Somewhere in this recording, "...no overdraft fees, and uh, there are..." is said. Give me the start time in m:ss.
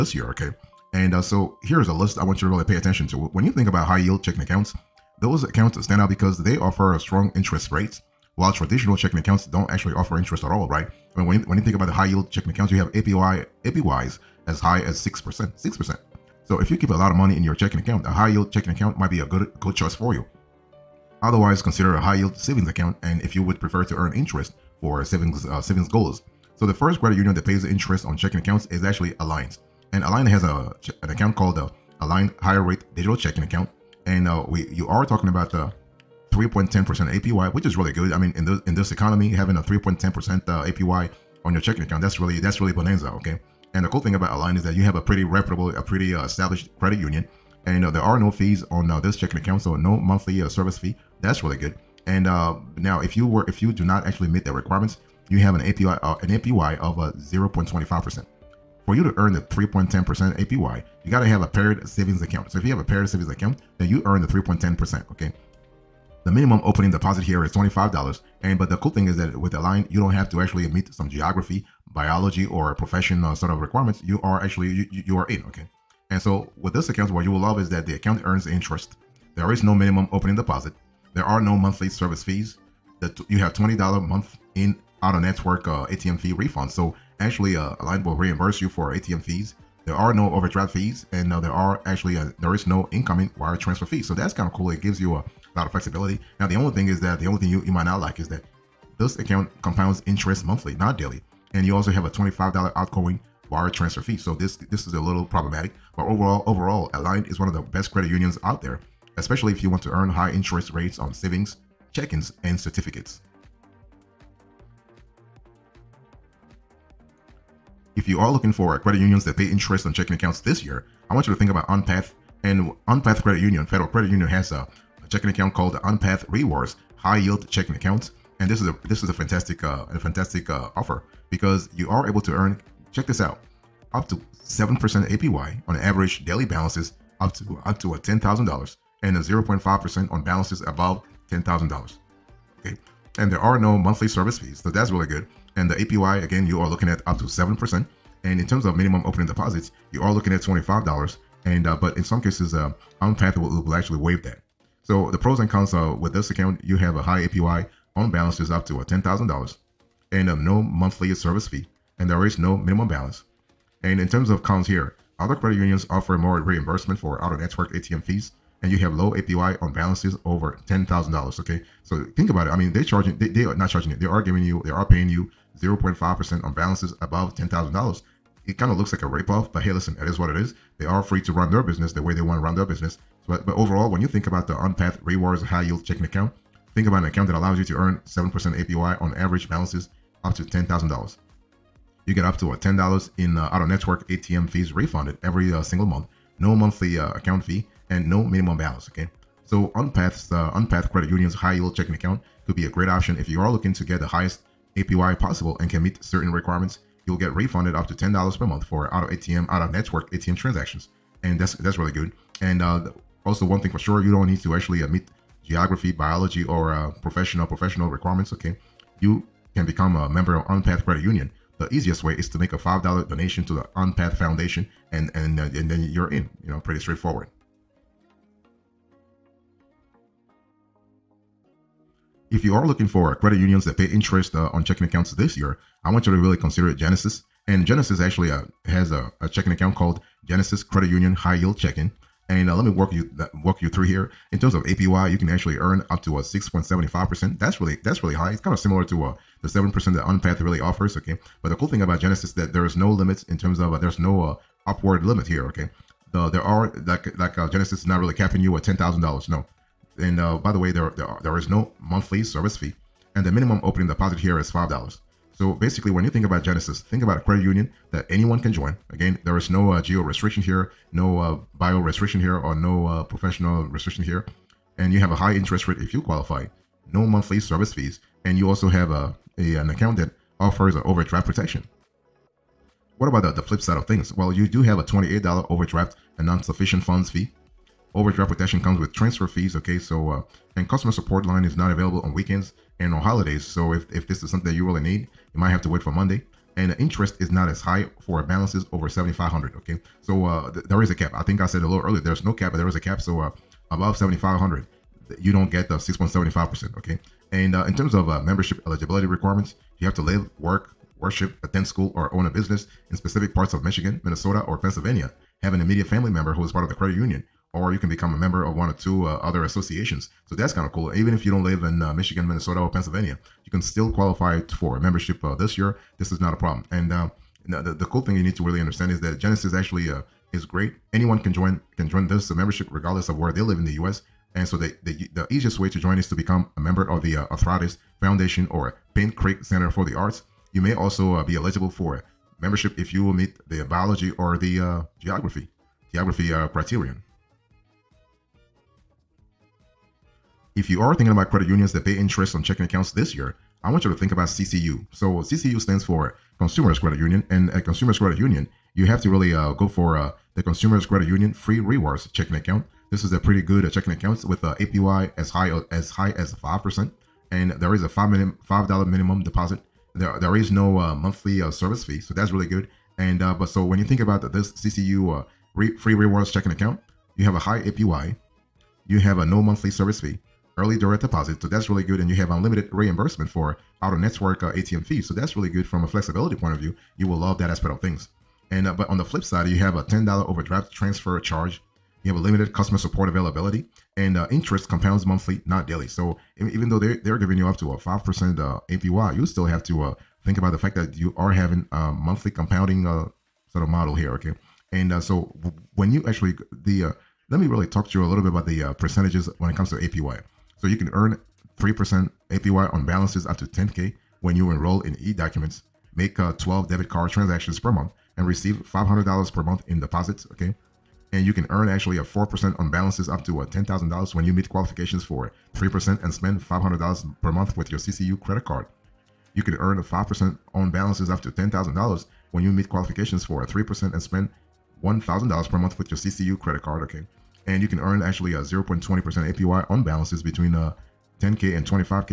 1:30.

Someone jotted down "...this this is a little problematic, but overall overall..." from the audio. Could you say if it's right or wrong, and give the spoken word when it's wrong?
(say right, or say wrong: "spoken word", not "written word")
right.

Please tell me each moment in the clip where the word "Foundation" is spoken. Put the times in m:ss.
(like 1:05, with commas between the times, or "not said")
3:44, 5:38.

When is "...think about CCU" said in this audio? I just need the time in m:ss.
5:53.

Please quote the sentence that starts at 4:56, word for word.
And the interest is not as high for balances over 7500 okay?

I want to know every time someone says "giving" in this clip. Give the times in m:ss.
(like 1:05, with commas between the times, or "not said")
2:54, 6:37.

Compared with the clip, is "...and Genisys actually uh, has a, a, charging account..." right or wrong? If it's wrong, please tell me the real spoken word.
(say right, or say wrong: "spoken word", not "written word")
wrong: "checking", not "charging".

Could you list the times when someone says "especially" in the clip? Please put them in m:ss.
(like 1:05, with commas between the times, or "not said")
1:49.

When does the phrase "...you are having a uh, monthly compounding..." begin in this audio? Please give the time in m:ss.
6:40.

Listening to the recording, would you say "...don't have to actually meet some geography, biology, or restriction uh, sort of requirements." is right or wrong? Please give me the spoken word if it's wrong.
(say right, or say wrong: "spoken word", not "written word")
wrong: "profession", not "restriction".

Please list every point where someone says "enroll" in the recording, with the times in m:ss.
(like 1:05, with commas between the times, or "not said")
6:54.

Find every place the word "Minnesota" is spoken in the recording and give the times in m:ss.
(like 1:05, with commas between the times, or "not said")
5:14, 5:22.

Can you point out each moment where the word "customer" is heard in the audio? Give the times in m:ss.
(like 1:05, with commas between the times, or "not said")
4:50, 6:32.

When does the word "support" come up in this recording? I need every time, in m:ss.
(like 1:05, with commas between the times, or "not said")
4:50, 6:32.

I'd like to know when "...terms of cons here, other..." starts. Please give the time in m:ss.
2:44.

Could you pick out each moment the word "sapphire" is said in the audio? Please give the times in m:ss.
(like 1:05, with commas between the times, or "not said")
not said.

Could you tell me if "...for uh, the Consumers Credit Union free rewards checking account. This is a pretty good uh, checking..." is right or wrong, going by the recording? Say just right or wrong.
right.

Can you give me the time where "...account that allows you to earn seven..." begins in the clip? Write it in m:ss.
3:07.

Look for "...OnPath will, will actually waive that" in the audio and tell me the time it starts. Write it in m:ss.
2:33.